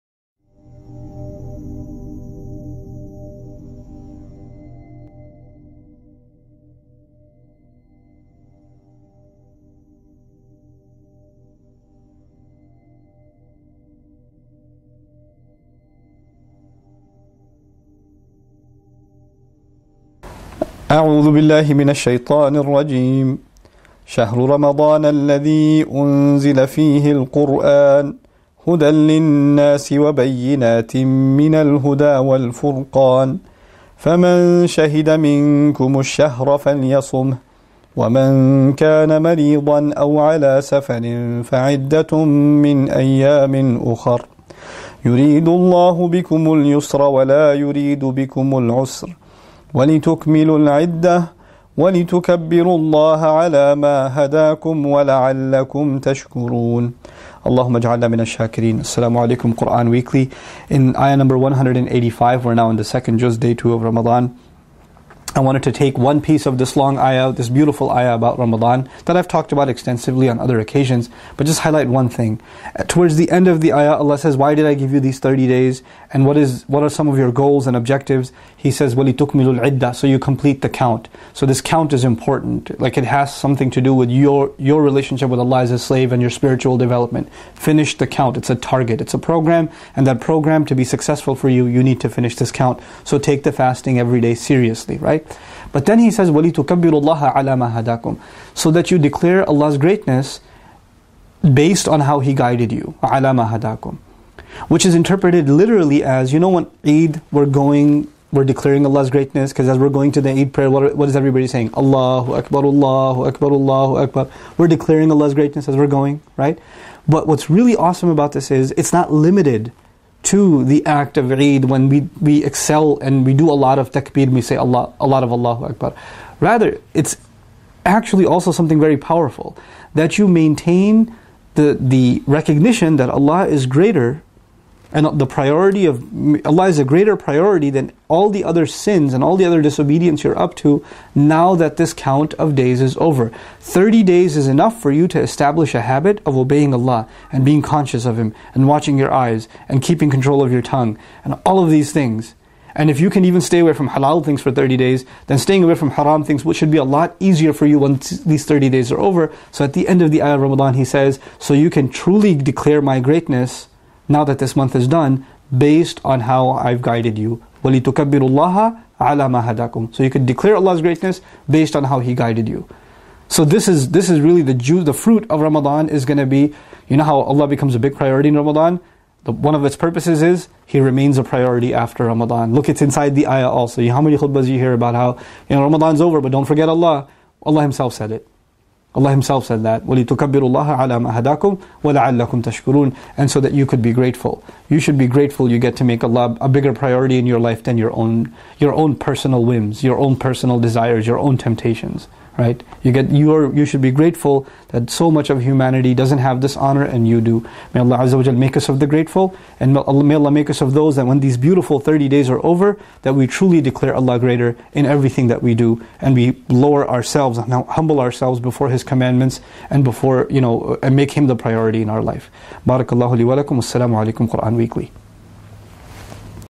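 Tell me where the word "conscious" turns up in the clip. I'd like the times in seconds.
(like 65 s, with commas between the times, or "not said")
147 s.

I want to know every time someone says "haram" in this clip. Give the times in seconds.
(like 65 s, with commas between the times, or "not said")
155 s.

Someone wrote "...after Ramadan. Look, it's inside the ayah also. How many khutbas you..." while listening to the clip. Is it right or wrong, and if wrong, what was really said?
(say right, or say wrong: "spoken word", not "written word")
right.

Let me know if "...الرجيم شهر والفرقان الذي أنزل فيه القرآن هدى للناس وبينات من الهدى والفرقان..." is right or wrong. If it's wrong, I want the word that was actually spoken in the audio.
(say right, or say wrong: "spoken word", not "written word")
wrong: "رمضان", not "والفرقان".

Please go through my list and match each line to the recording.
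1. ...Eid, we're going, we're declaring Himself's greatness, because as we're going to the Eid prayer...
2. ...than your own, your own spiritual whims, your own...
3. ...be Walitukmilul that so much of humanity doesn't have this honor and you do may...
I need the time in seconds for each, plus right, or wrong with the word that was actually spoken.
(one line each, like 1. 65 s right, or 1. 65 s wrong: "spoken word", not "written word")
1. 106 s wrong: "Allah", not "Himself"
2. 197 s wrong: "personal", not "spiritual"
3. 203 s wrong: "grateful", not "Walitukmilul".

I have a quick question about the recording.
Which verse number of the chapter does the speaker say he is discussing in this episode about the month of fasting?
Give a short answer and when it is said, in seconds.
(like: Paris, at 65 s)
185, at 61 s.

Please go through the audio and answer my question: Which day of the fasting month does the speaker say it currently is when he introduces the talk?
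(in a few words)
Day 2.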